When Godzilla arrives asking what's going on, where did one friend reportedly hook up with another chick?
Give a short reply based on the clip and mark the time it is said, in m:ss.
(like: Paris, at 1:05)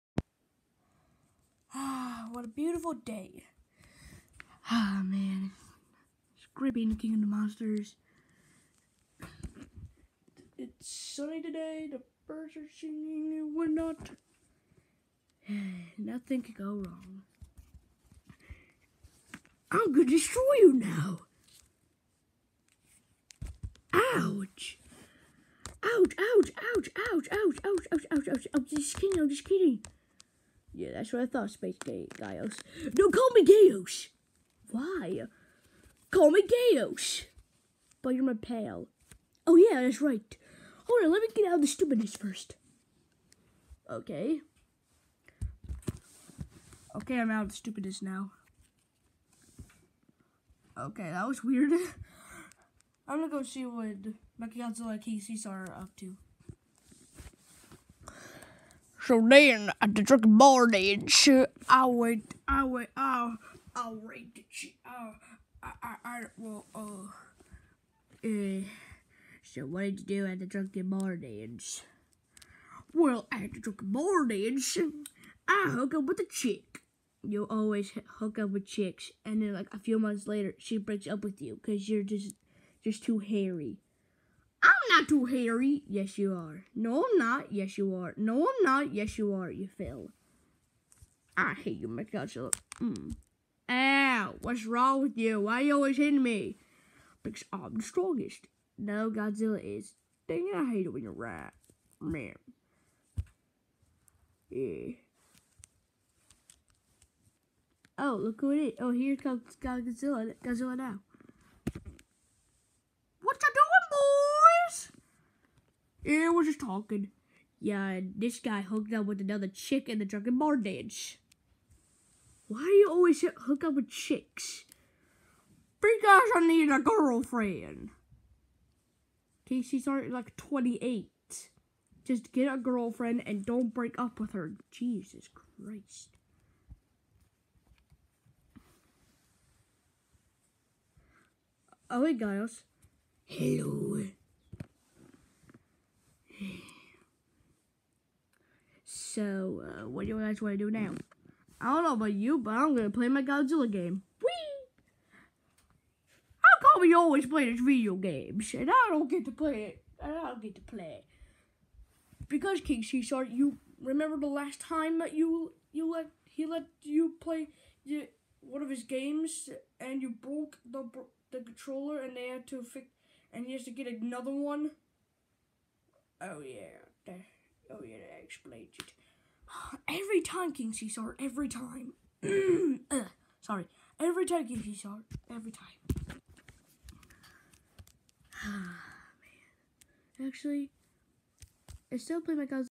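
drunken bar dance, at 2:00.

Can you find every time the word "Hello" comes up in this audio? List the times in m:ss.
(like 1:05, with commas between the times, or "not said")
2:23.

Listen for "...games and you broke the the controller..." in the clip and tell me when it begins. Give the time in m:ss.
2:48.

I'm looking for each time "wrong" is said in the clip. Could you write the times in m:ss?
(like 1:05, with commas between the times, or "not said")
0:16, 1:34.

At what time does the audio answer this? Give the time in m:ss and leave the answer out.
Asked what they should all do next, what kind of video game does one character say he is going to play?
2:33.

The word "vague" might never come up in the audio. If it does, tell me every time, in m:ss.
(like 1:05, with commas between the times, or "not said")
not said.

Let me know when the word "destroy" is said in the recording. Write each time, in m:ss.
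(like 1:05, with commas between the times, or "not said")
0:20.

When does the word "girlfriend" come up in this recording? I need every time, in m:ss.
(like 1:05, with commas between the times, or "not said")
2:06, 2:12.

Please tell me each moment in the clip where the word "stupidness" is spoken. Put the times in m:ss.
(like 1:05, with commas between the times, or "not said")
0:41, 0:47.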